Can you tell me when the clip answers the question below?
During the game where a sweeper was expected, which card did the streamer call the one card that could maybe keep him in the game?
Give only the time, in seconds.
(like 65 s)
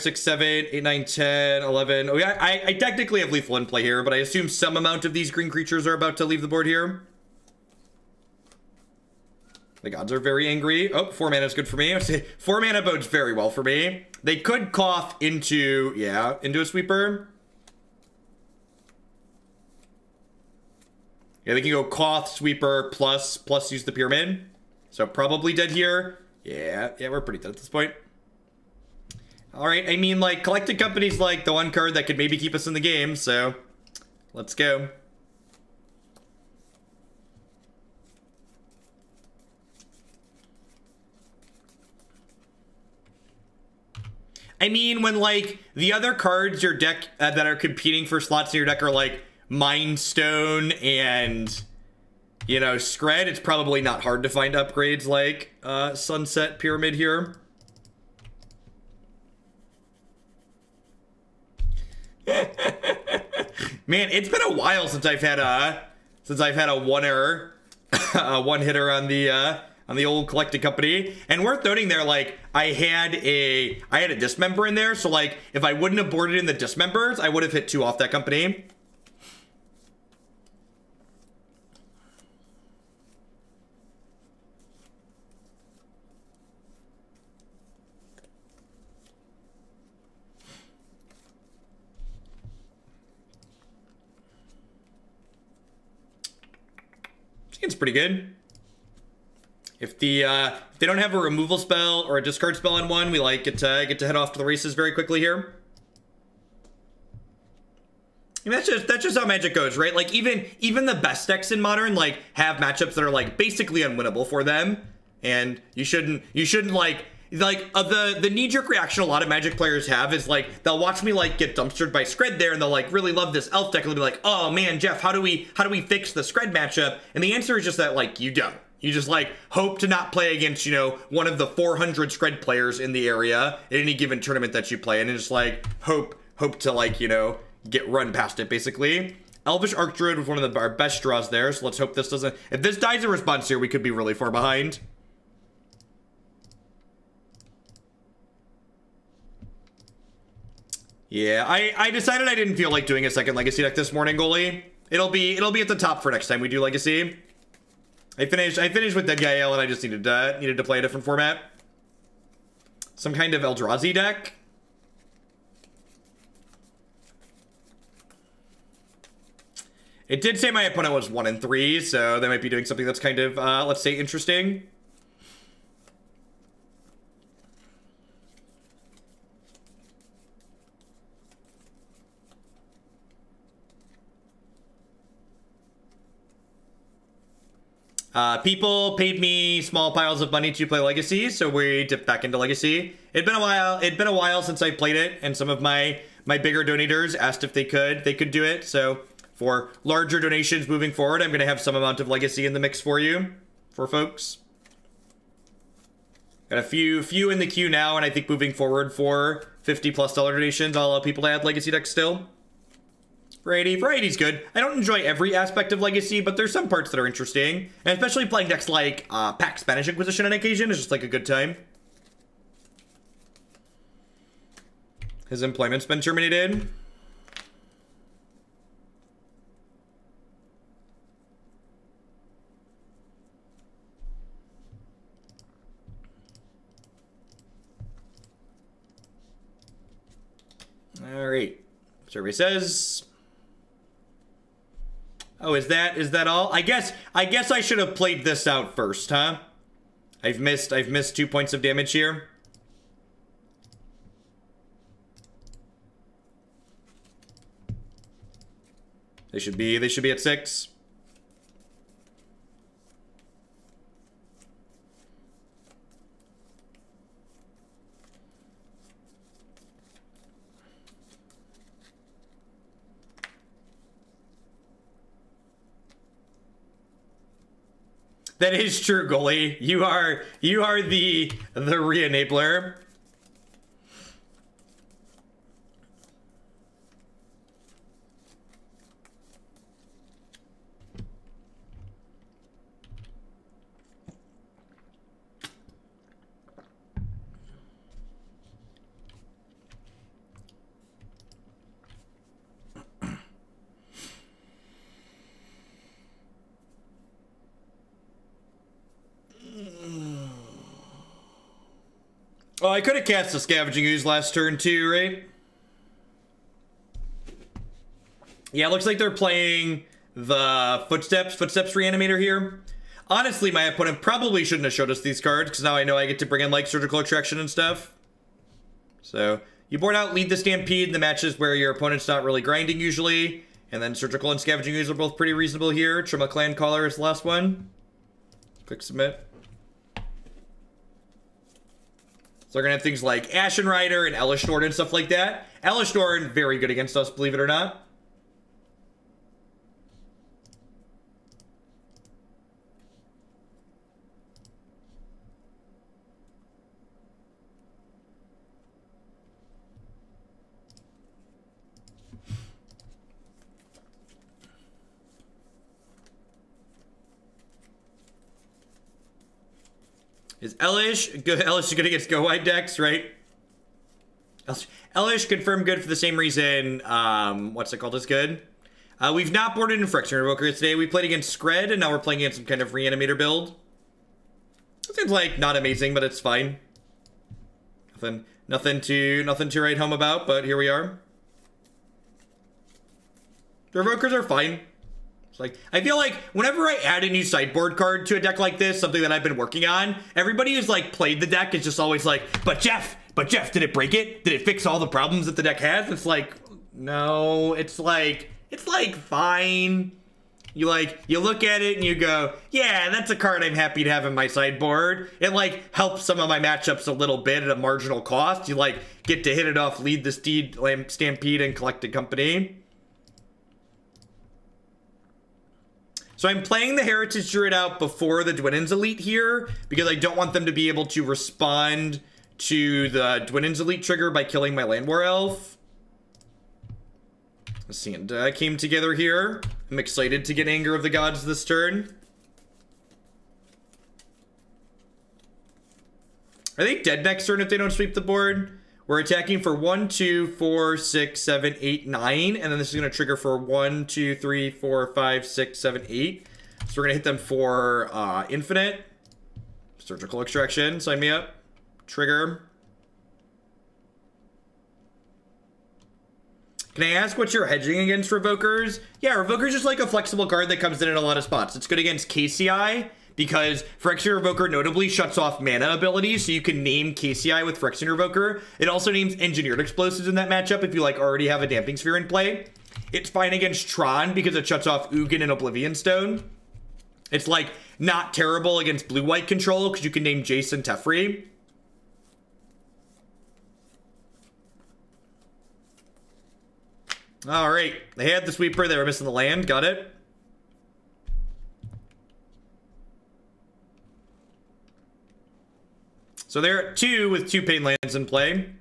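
30 s.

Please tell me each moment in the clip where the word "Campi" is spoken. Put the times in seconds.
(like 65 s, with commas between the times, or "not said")
not said.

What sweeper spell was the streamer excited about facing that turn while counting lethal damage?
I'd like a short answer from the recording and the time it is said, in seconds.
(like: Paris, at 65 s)
Anger of the Gods, at 440 s.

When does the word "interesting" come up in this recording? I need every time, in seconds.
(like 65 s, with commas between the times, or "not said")
173 s, 217 s.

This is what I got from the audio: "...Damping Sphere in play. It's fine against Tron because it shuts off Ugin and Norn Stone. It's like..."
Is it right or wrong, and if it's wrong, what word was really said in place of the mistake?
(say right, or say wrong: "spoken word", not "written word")
wrong: "Oblivion", not "Norn".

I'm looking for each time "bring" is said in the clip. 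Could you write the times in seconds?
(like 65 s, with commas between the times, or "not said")
326 s.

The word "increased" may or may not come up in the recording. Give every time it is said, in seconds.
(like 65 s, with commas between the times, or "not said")
not said.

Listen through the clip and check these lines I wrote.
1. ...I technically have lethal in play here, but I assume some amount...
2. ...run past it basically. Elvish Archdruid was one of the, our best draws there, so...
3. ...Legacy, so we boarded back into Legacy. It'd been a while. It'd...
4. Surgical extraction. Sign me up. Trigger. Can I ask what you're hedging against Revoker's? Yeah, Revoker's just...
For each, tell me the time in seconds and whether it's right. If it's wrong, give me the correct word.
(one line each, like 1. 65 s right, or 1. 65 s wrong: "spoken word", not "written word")
1. 2 s right
2. 137 s right
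3. 190 s wrong: "dipped", not "boarded"
4. 459 s right.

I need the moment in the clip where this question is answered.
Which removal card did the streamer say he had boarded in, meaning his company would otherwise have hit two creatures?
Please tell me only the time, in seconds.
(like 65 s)
74 s.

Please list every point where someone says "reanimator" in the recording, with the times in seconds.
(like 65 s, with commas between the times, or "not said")
321 s, 382 s.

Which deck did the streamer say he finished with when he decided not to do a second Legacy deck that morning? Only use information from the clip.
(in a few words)
Deadguy Ale.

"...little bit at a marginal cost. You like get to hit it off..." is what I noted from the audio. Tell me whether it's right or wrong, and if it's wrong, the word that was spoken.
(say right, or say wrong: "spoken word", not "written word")
right.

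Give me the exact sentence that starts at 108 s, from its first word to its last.
And that's just that's just how Magic goes, right?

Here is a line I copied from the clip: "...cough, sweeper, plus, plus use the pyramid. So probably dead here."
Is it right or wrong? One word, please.
right.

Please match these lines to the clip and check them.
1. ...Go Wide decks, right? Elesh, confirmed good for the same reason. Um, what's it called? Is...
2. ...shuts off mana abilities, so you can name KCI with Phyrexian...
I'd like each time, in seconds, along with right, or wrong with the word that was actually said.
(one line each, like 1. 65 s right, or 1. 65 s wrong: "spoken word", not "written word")
1. 372 s right
2. 474 s right.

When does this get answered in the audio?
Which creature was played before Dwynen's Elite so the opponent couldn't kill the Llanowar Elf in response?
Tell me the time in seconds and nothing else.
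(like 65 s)
426 s.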